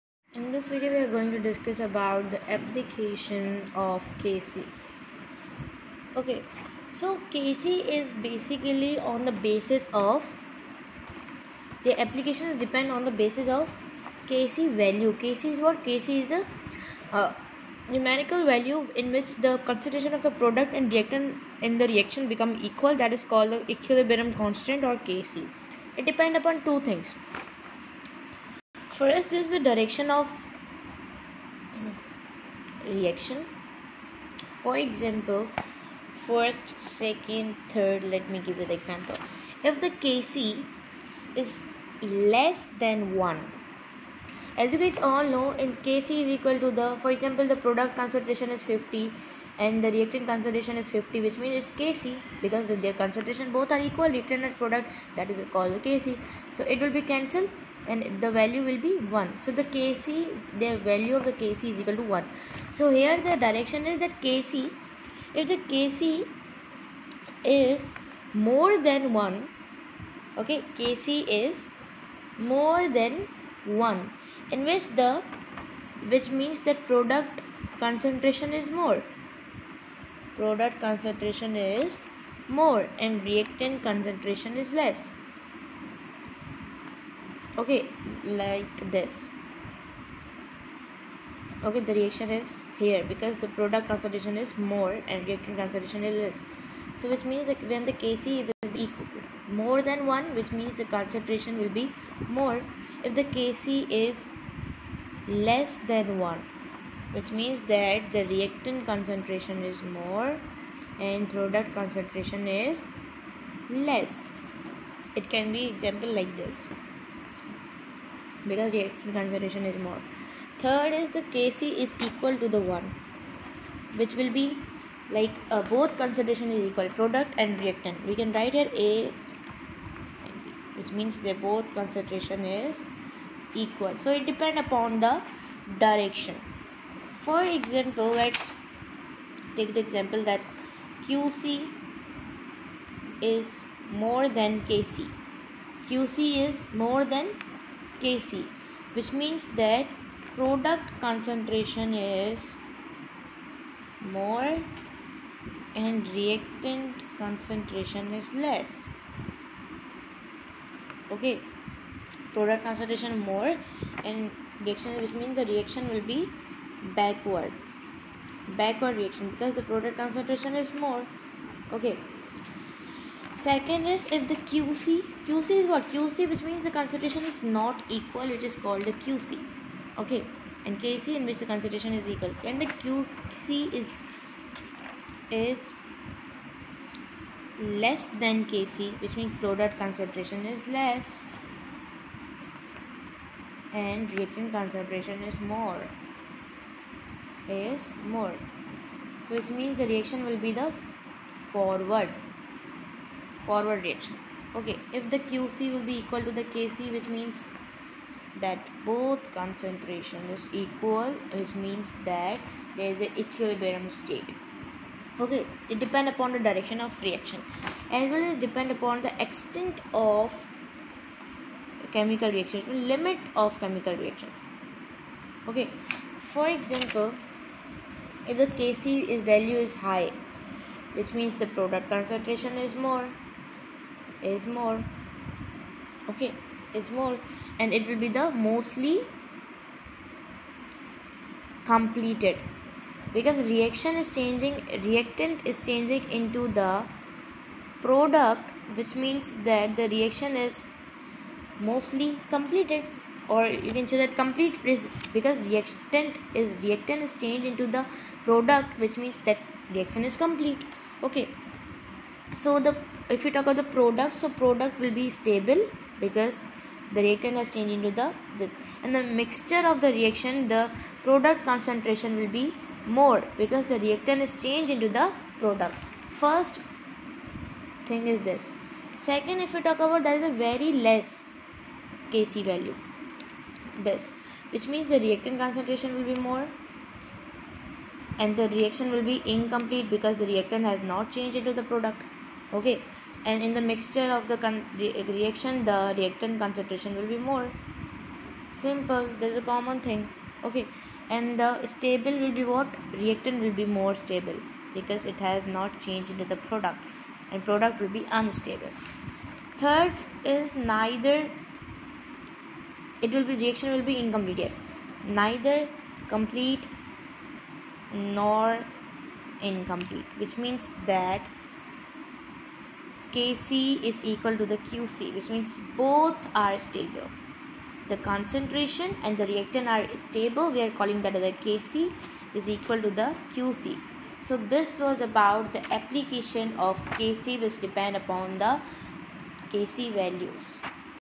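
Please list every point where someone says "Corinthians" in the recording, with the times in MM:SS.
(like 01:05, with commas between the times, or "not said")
not said.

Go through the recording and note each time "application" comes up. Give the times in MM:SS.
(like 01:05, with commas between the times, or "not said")
00:02, 00:12, 05:35.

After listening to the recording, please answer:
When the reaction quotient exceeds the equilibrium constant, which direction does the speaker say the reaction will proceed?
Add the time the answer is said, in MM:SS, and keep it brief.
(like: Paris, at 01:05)
Backward, at 02:48.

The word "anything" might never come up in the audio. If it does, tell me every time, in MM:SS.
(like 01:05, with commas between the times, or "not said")
not said.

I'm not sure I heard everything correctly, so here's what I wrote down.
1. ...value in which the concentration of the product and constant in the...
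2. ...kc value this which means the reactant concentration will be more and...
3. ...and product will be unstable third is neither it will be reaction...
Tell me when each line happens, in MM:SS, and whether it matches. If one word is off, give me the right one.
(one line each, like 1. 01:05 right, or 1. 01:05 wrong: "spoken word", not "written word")
1. 00:18 wrong: "reactant", not "constant"
2. 04:42 right
3. 05:07 right.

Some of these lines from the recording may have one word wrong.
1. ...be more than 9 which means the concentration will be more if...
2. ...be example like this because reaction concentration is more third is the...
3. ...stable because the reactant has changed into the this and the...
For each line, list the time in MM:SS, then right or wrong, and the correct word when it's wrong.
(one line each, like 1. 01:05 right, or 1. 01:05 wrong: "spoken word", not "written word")
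1. 01:38 wrong: "1", not "9"
2. 01:55 right
3. 04:25 right.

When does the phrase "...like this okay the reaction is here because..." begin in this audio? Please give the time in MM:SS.
01:28.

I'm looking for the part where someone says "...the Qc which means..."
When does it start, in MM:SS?
05:24.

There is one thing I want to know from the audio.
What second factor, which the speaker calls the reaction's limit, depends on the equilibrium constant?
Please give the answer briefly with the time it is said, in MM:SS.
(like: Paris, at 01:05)
Extent of chemical reaction, at 03:39.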